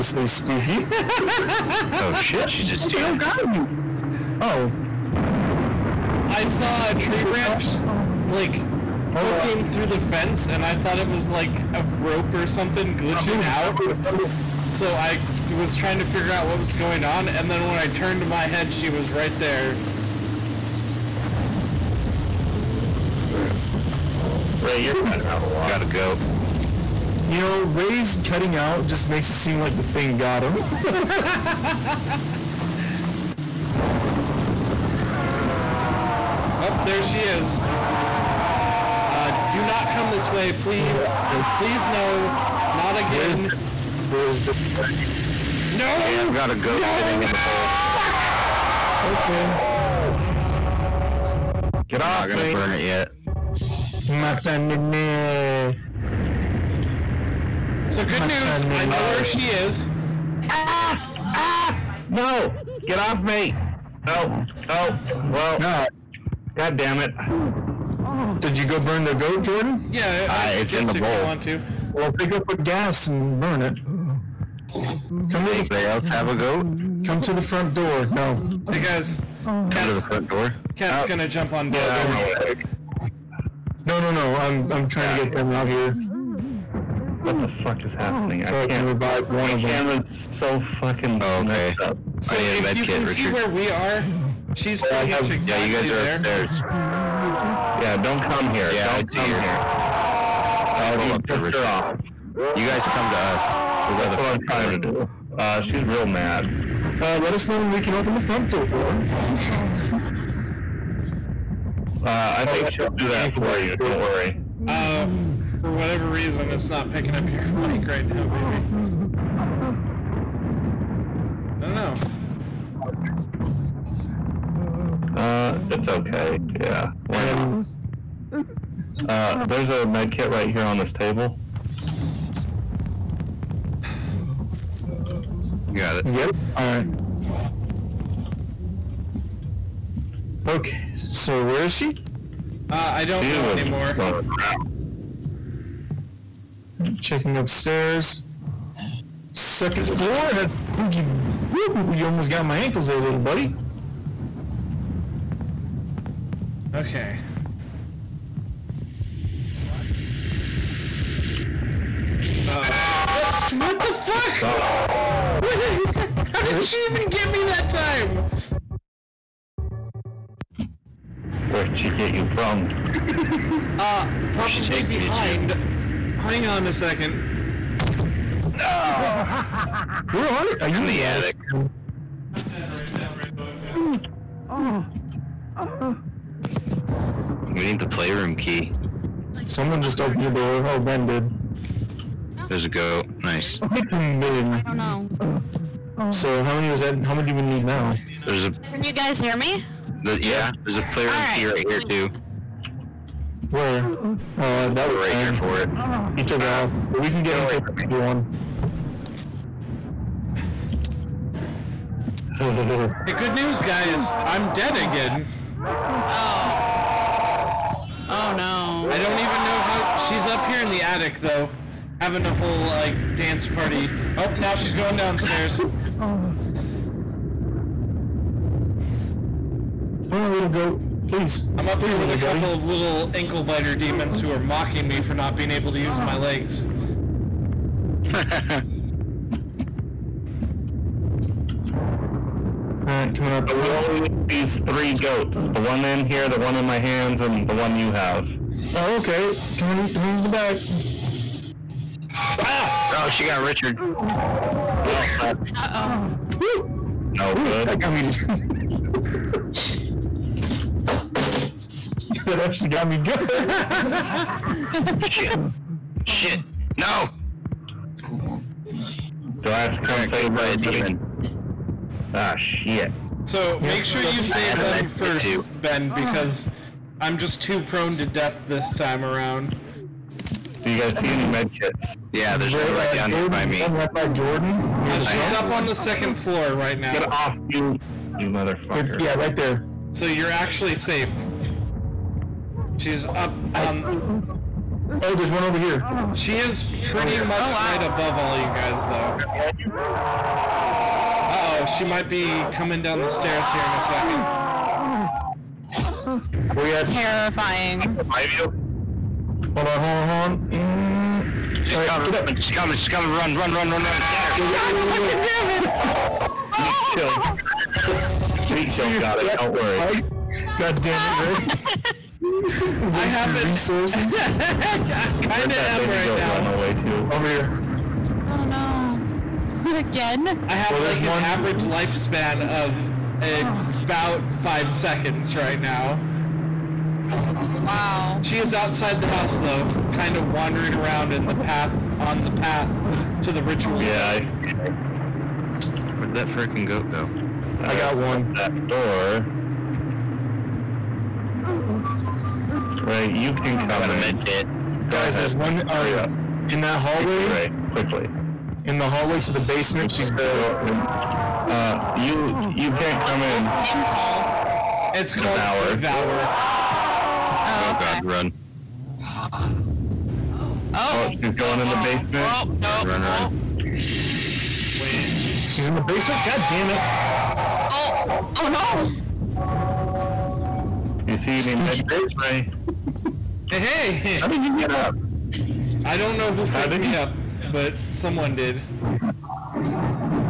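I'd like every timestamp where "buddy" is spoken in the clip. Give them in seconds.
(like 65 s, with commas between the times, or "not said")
153 s, 232 s.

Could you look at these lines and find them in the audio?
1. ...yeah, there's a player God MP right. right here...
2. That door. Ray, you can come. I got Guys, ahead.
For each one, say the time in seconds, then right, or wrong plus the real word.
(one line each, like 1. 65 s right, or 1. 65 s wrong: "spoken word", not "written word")
1. 200 s wrong: "All", not "God"
2. 348 s right.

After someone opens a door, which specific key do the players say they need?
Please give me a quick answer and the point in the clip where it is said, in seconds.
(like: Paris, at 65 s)
The playroom key, at 187 s.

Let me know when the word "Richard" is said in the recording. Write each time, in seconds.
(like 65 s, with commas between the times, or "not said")
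93 s, 253 s.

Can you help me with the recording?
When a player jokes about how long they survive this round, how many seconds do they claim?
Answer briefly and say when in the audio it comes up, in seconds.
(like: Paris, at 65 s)
5 seconds, at 334 s.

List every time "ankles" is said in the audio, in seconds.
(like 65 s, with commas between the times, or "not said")
152 s, 233 s.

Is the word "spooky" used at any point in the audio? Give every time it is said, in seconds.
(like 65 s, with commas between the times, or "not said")
0 s, 150 s.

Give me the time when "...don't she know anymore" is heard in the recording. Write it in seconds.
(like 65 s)
143 s.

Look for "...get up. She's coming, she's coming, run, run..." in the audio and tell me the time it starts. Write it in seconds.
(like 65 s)
312 s.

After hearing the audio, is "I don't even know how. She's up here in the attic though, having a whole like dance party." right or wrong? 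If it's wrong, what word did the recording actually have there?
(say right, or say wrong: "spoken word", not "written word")
right.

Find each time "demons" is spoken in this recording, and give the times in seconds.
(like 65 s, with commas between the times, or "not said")
233 s, 270 s.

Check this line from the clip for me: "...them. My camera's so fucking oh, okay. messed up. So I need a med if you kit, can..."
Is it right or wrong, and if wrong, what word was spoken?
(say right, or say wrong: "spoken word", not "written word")
right.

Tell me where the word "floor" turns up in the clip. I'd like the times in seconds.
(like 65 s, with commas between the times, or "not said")
149 s, 286 s.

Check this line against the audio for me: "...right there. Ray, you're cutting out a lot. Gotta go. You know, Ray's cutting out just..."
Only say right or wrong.
right.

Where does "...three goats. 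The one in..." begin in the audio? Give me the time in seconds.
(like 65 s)
244 s.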